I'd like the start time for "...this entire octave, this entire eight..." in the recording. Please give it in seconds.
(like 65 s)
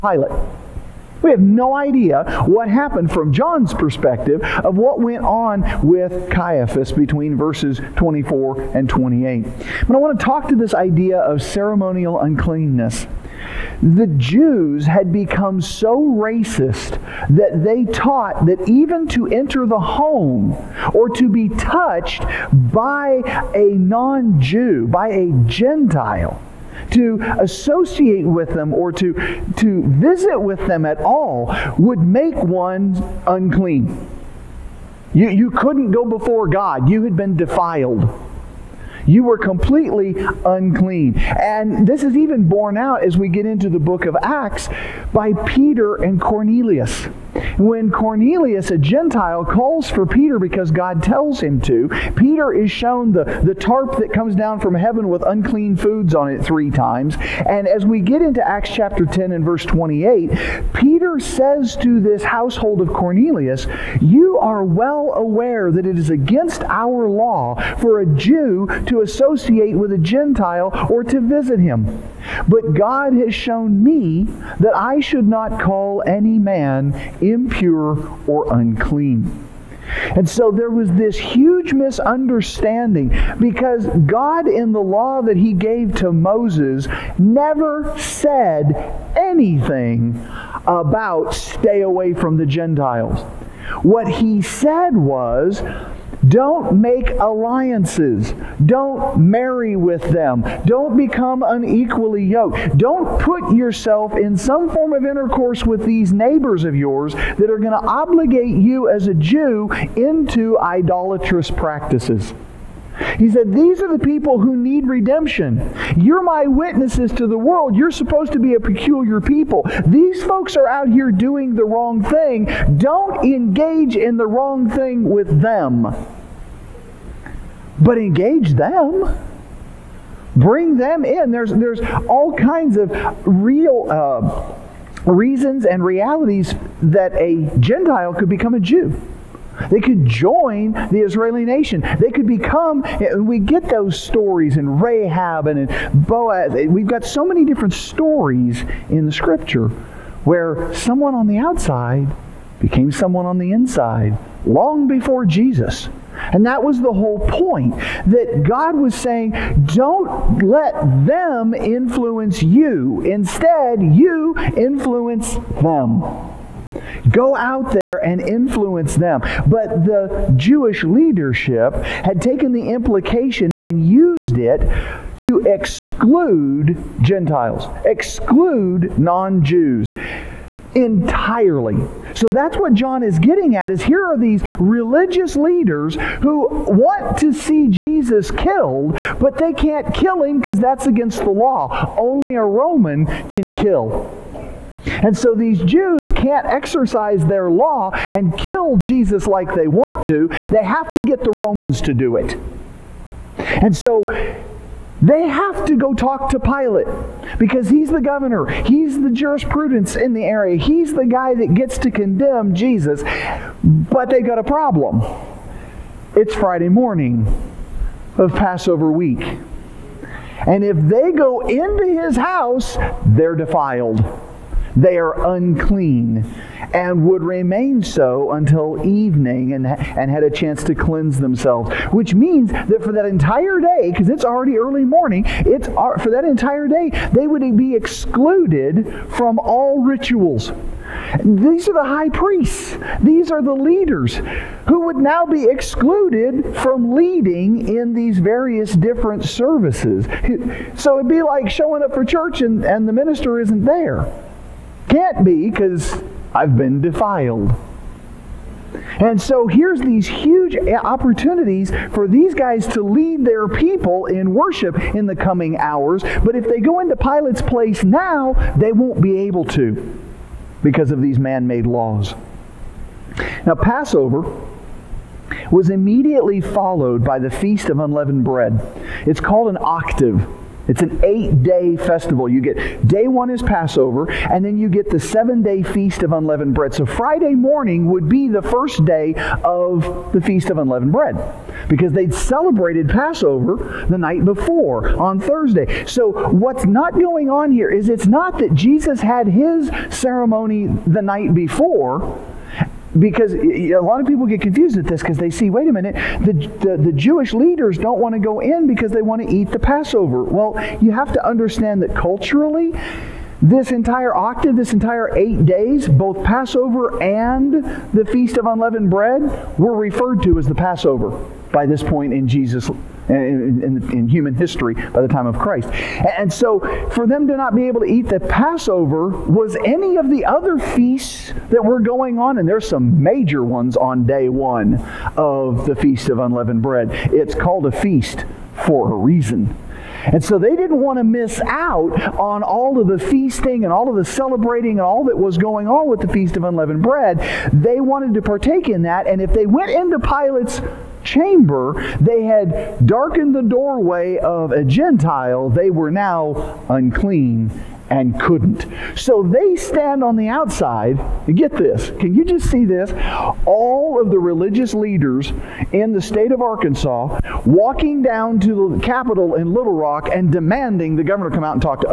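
313 s.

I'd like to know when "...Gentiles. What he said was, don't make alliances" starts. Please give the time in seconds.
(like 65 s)
92 s.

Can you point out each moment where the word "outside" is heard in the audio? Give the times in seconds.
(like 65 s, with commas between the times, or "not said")
151 s, 360 s.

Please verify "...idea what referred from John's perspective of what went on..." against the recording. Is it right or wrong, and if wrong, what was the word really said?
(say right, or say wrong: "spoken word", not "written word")
wrong: "happened", not "referred".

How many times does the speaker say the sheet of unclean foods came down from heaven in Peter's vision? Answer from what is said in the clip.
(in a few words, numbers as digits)
3.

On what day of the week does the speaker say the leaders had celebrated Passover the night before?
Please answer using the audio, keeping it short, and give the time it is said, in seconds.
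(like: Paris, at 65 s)
Thursday, at 295 s.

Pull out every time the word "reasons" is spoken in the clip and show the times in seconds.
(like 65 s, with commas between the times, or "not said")
135 s, 338 s.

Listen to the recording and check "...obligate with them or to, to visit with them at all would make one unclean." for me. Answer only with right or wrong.
wrong.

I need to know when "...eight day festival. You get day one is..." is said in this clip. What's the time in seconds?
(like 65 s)
281 s.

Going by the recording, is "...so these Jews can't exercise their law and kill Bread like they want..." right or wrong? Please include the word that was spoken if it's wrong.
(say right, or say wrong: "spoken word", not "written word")
wrong: "Jesus", not "Bread".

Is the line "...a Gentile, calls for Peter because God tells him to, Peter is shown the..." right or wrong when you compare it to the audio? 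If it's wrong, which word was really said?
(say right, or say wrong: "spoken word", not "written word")
right.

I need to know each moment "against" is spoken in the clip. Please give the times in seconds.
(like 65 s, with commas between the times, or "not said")
66 s, 190 s.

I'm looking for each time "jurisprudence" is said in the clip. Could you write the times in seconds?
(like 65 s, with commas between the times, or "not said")
209 s.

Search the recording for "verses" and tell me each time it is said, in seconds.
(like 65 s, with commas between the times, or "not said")
7 s, 59 s.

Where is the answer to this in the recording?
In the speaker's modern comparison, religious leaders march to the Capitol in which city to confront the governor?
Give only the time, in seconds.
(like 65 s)
369 s.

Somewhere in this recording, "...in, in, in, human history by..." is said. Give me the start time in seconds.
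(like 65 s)
323 s.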